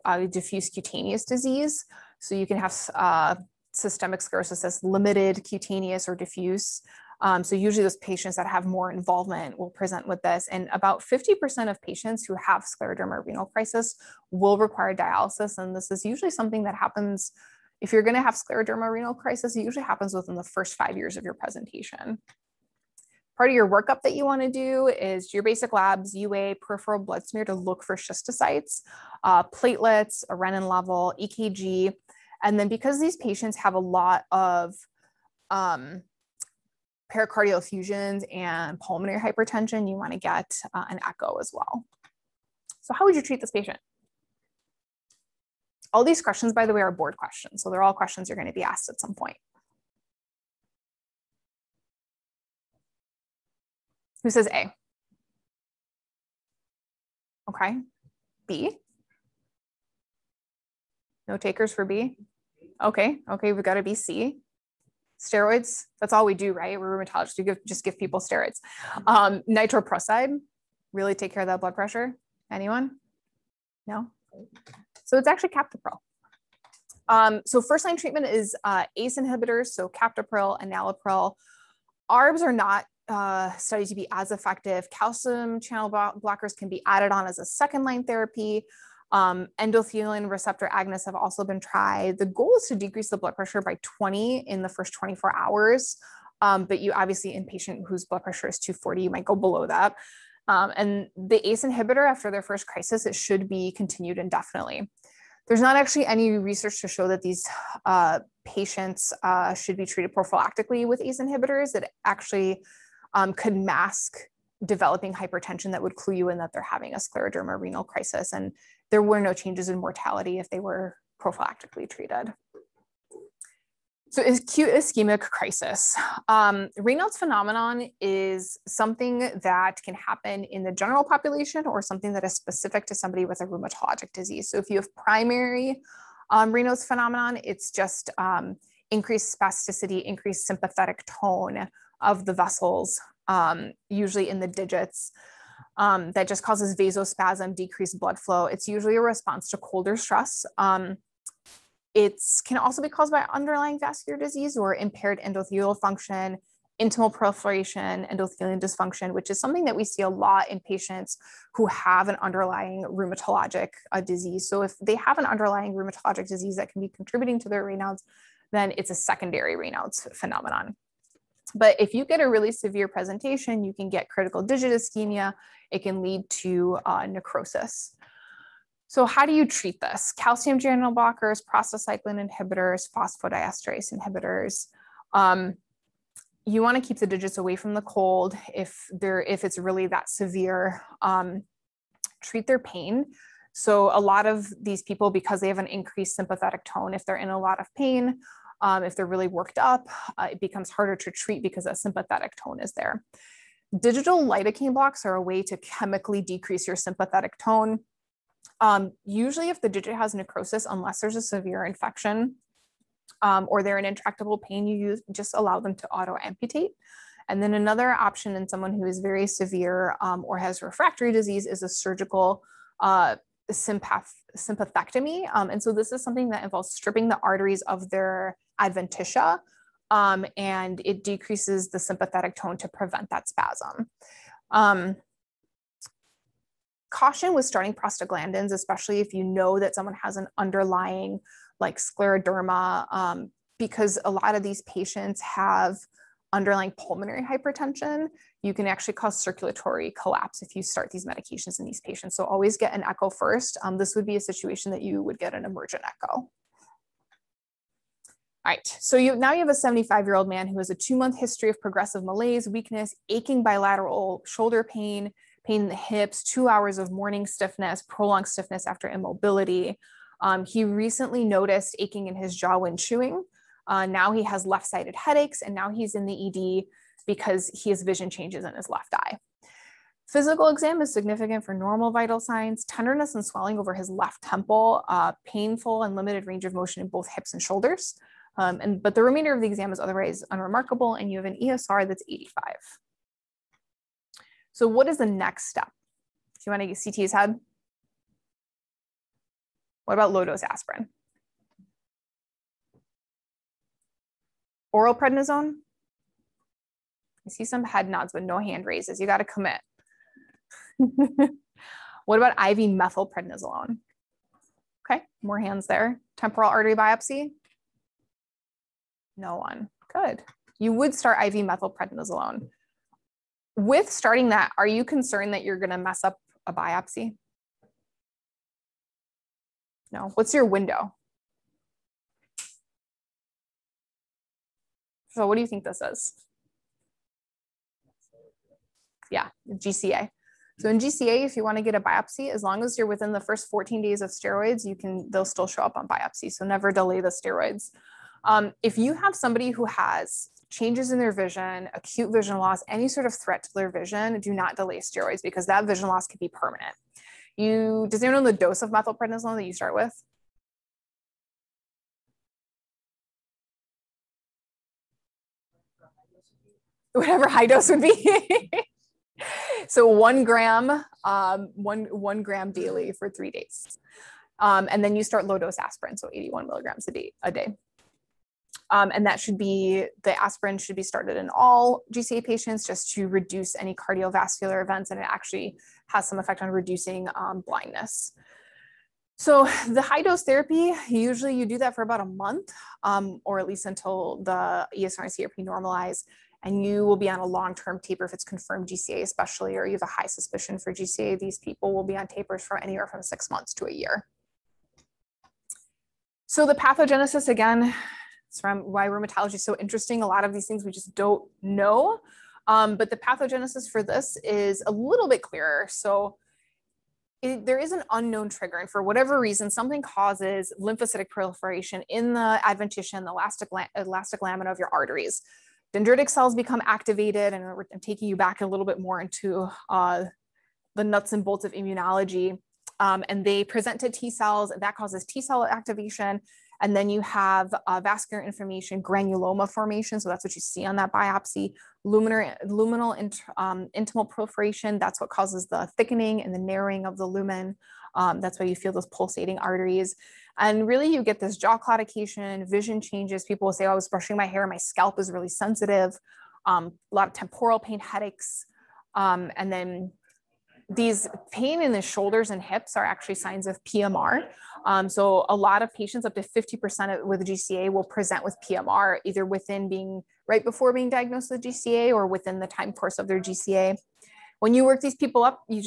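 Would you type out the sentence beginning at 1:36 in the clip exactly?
Um, but you obviously, in patient whose blood pressure is 240, you might go below that.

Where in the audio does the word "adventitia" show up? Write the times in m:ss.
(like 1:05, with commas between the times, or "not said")
3:48, 7:02.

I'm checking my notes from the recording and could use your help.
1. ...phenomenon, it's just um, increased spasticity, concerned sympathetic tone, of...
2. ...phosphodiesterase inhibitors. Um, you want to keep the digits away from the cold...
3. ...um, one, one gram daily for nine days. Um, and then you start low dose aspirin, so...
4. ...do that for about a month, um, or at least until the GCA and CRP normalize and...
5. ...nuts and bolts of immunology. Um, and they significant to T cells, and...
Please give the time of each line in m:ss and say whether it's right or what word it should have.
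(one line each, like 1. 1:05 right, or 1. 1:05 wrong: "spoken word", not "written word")
1. 2:16 wrong: "increased", not "concerned"
2. 3:02 right
3. 6:11 wrong: "three", not "nine"
4. 6:31 wrong: "ESR", not "GCA"
5. 7:10 wrong: "present", not "significant".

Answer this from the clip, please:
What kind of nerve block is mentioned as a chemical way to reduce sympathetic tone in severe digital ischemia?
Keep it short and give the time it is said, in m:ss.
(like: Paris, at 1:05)
digital lidocaine blocks, at 3:23.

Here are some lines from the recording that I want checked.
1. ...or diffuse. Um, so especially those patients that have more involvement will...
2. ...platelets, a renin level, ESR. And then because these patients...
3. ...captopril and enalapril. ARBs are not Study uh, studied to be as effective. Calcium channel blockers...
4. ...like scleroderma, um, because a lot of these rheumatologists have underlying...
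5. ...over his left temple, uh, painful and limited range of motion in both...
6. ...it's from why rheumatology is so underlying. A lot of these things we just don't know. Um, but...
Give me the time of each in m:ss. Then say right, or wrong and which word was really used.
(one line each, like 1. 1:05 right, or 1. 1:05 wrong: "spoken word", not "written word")
1. 0:06 wrong: "usually", not "especially"
2. 0:29 wrong: "EKG", not "ESR"
3. 1:19 right
4. 4:01 wrong: "patients", not "rheumatologists"
5. 4:43 right
6. 6:48 wrong: "interesting", not "underlying".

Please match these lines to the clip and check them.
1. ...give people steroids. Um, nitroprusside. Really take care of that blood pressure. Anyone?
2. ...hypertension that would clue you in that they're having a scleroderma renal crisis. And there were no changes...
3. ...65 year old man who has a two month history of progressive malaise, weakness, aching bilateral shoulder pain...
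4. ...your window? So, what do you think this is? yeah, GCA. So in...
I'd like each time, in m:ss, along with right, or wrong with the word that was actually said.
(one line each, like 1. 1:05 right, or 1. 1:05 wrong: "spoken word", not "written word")
1. 1:07 right
2. 1:55 right
3. 4:19 wrong: "75", not "65"
4. 5:30 right.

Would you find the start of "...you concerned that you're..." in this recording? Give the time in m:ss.
5:24.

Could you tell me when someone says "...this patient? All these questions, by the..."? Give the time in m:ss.
0:43.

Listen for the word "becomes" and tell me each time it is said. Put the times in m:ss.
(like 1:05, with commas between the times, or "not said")
3:20, 7:06.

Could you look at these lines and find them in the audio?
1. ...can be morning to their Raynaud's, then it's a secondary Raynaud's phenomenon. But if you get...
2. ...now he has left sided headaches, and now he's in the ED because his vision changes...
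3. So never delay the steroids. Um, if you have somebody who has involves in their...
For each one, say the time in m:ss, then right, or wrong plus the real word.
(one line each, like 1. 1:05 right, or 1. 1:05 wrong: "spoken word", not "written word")
1. 2:46 wrong: "contributing", not "morning"
2. 4:33 right
3. 5:46 wrong: "changes", not "involves".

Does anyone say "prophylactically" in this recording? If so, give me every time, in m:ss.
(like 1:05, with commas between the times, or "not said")
1:50, 2:01.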